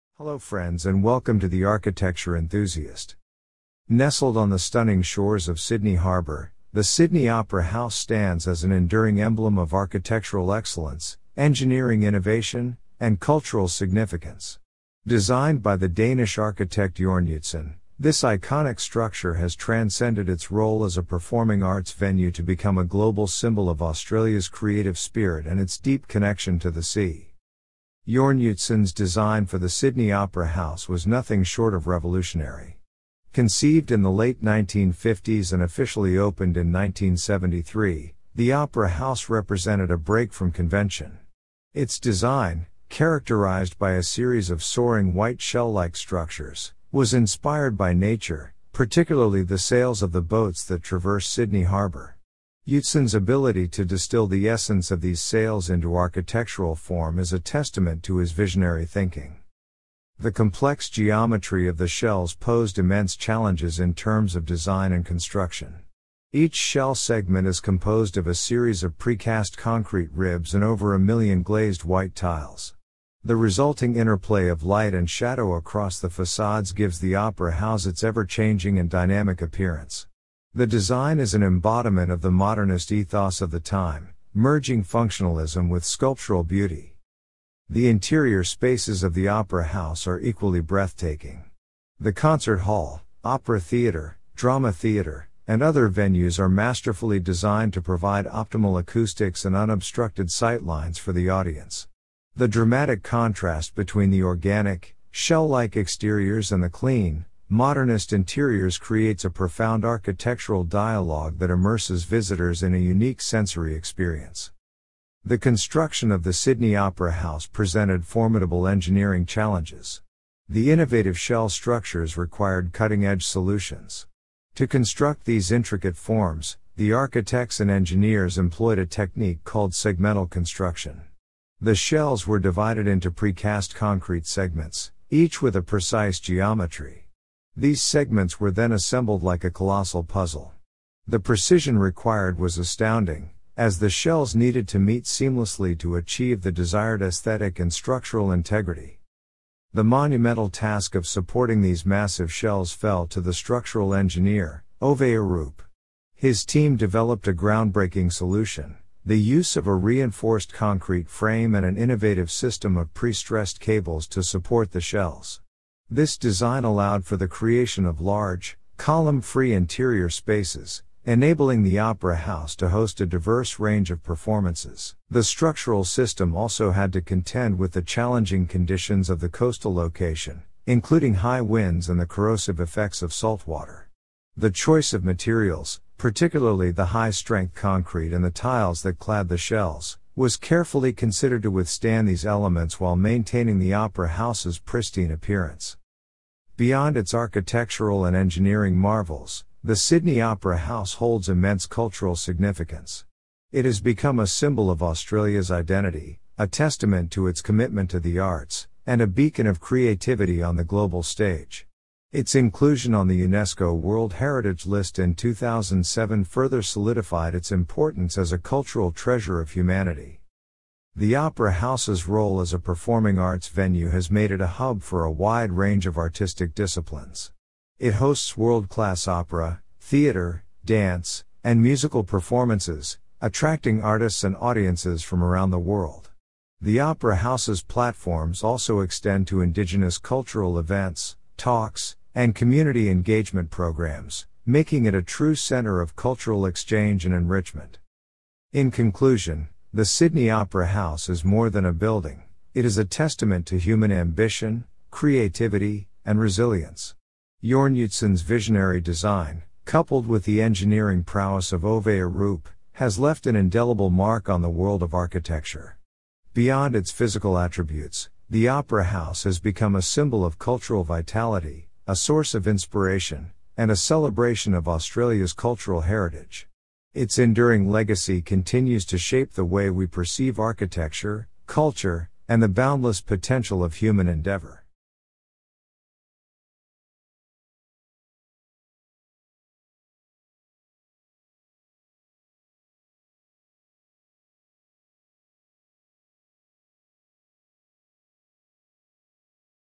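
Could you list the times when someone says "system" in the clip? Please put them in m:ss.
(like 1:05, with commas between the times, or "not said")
2:42, 2:55.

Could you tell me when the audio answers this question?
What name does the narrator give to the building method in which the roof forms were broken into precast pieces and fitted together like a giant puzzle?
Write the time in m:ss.
2:09.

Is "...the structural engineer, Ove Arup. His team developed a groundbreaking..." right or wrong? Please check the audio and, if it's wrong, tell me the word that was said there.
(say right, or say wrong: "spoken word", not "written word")
right.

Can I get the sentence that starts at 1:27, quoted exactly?
The interior spaces of the Opera House are equally breathtaking.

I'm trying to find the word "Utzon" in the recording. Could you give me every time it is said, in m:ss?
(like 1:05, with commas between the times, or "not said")
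0:17, 0:28, 0:52, 4:17.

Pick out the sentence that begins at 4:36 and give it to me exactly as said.
Its enduring legacy continues to shape the way we perceive architecture, culture, and the boundless potential of human endeavor.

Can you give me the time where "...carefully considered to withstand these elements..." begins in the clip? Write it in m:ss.
3:10.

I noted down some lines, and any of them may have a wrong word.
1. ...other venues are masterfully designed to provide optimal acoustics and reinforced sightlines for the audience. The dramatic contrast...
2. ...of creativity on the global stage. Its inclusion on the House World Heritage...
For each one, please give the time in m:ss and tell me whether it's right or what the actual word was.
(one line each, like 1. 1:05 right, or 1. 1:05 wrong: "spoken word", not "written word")
1. 1:35 wrong: "unobstructed", not "reinforced"
2. 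3:29 wrong: "UNESCO", not "House".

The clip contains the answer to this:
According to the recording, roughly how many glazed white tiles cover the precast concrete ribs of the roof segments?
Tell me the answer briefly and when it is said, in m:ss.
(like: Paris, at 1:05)
over a million, at 1:10.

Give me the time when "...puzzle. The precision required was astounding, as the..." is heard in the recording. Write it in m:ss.
2:20.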